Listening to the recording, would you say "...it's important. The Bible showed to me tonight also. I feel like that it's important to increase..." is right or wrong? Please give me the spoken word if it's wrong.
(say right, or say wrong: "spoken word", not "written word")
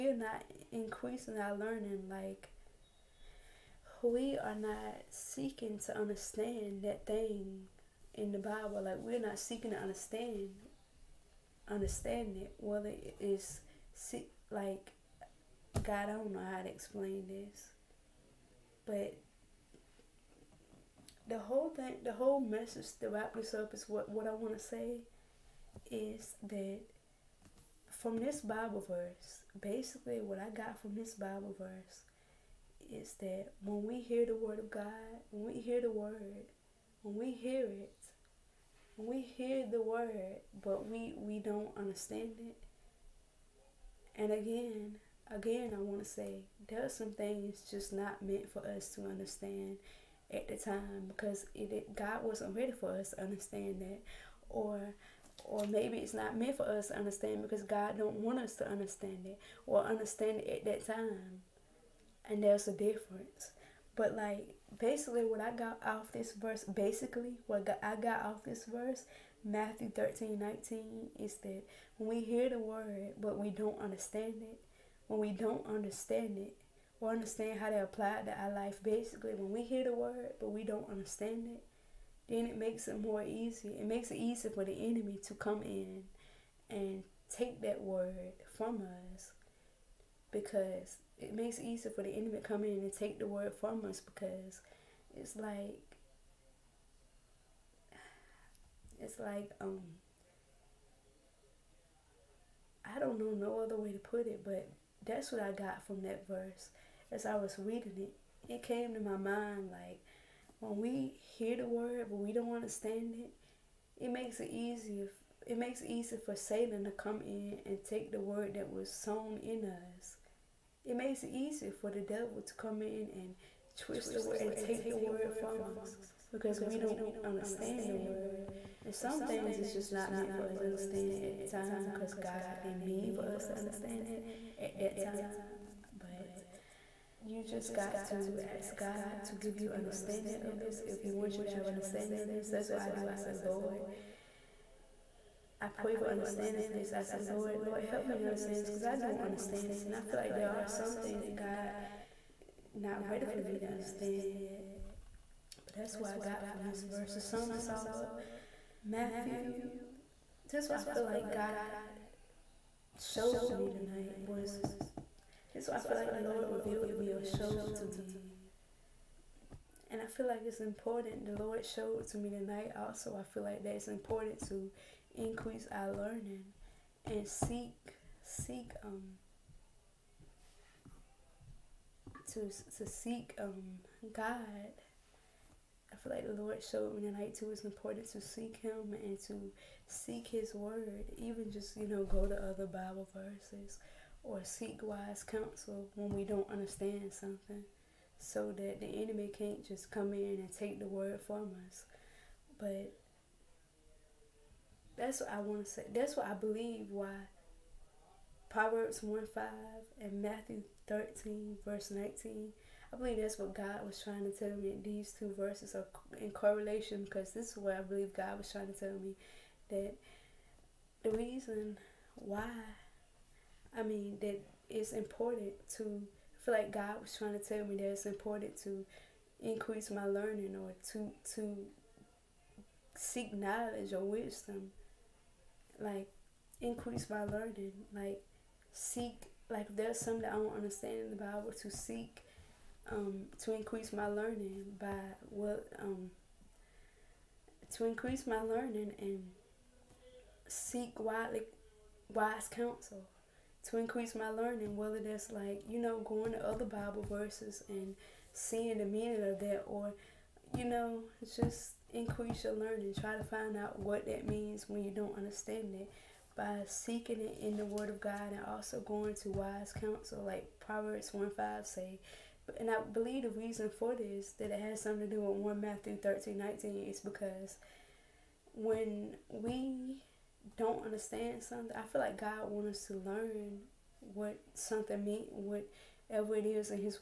wrong: "Lord", not "Bible".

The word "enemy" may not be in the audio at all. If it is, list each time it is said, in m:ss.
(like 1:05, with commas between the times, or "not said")
1:24, 1:32, 3:19.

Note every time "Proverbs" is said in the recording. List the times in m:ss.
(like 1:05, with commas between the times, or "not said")
3:28, 4:30.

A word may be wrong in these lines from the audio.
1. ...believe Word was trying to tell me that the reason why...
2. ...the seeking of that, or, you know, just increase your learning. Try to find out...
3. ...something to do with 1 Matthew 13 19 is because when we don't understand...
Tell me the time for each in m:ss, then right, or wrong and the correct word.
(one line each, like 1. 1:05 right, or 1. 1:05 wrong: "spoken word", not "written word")
1. 3:37 wrong: "God", not "Word"
2. 4:18 wrong: "meaning", not "seeking"
3. 4:34 right.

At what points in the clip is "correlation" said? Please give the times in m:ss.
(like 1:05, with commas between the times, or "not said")
3:36.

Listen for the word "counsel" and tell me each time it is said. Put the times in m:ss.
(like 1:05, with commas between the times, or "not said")
3:15, 4:12, 4:29.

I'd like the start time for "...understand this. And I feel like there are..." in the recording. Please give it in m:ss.
2:29.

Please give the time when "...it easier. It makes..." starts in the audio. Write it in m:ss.
1:54.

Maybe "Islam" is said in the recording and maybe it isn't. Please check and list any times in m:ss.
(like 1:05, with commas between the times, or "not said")
not said.